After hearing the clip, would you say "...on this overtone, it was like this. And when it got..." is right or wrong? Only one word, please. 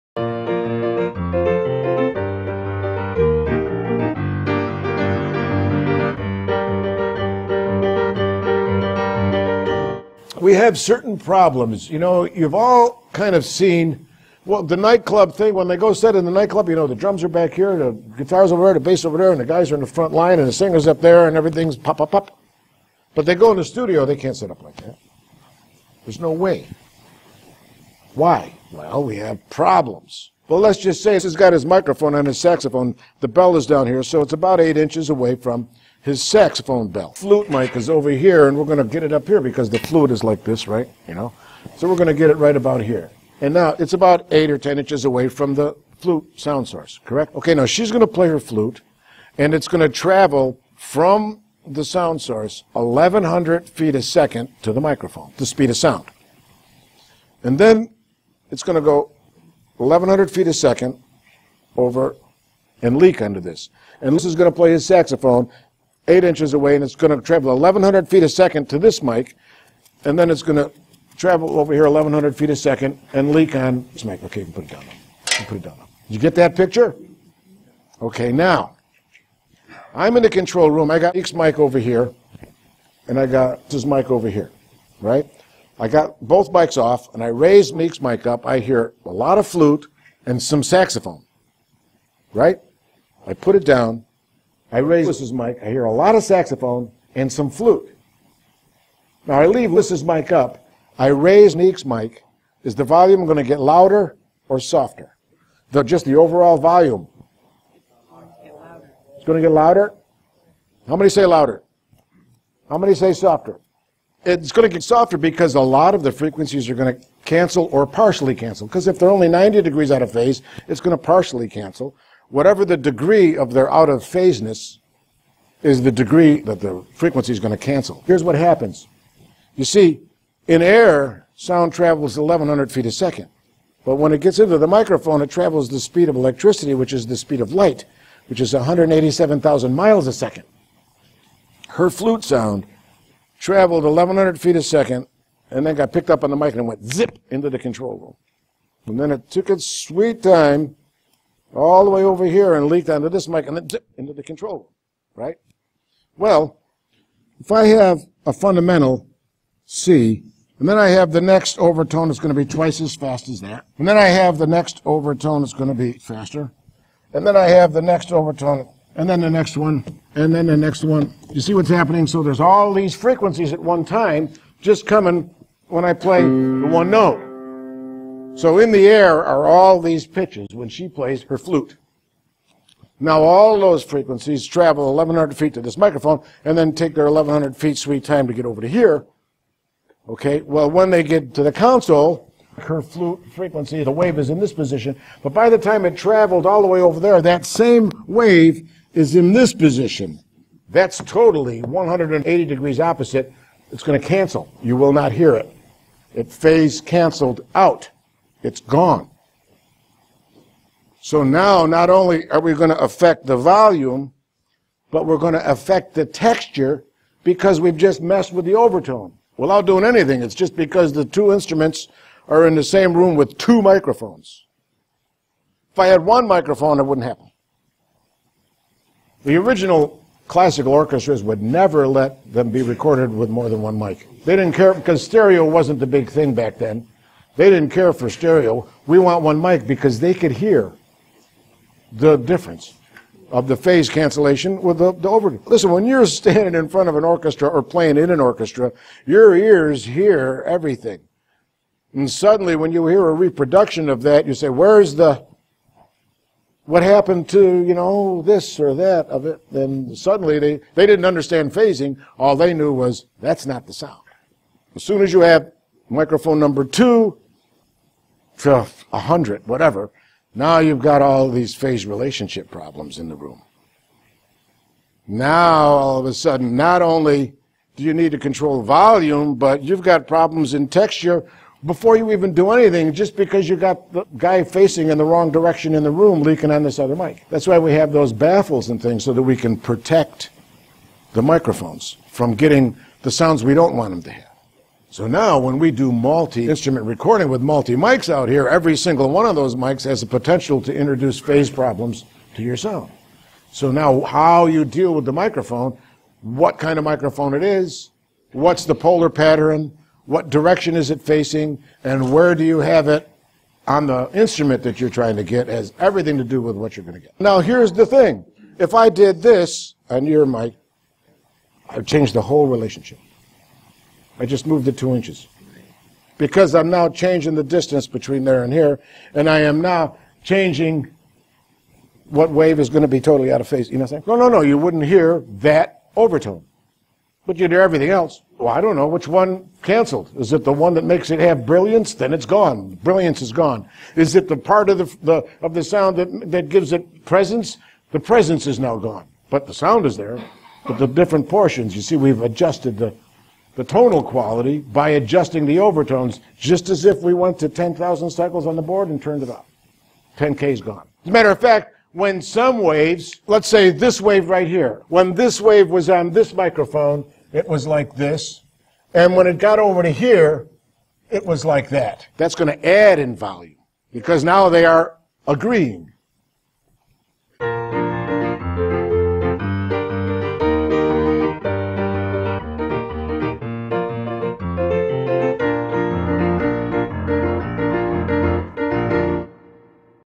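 wrong.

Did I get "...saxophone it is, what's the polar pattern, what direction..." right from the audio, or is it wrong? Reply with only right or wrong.
wrong.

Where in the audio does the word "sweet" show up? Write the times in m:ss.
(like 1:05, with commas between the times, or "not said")
2:29, 3:07.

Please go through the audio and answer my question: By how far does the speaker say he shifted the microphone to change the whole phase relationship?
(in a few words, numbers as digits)
2 inches.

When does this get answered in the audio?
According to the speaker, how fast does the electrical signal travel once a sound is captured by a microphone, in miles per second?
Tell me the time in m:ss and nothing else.
2:18.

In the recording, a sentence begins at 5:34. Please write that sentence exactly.
No, no, no, you wouldn't hear that overtone.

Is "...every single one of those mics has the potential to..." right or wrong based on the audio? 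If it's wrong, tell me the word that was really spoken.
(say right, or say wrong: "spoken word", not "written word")
right.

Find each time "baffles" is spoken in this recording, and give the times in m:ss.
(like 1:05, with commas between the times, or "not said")
4:48.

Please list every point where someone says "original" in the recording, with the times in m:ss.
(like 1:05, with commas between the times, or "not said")
3:49.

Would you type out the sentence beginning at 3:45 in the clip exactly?
If I had one microphone, it wouldn't happen.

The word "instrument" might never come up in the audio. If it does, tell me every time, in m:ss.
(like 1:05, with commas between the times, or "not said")
3:41, 4:56, 5:14.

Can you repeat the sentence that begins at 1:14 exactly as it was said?
Okay, you can put it down.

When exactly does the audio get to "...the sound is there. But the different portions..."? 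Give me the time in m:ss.
5:49.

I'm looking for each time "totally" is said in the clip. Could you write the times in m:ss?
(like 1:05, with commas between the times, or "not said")
3:20, 5:33.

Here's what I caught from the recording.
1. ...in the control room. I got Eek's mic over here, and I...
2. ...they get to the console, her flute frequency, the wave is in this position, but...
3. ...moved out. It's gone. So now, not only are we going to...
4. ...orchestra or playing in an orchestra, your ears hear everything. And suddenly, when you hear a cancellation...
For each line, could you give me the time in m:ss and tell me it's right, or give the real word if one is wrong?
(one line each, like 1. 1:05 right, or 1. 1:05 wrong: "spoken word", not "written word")
1. 1:20 right
2. 3:10 right
3. 3:26 wrong: "canceled", not "moved"
4. 4:07 wrong: "reproduction", not "cancellation".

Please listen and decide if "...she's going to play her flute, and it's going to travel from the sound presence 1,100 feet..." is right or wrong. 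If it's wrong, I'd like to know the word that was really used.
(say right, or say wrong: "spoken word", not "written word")
wrong: "source", not "presence".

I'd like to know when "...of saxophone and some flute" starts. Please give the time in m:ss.
1:36.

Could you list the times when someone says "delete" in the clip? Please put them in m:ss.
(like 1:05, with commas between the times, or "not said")
not said.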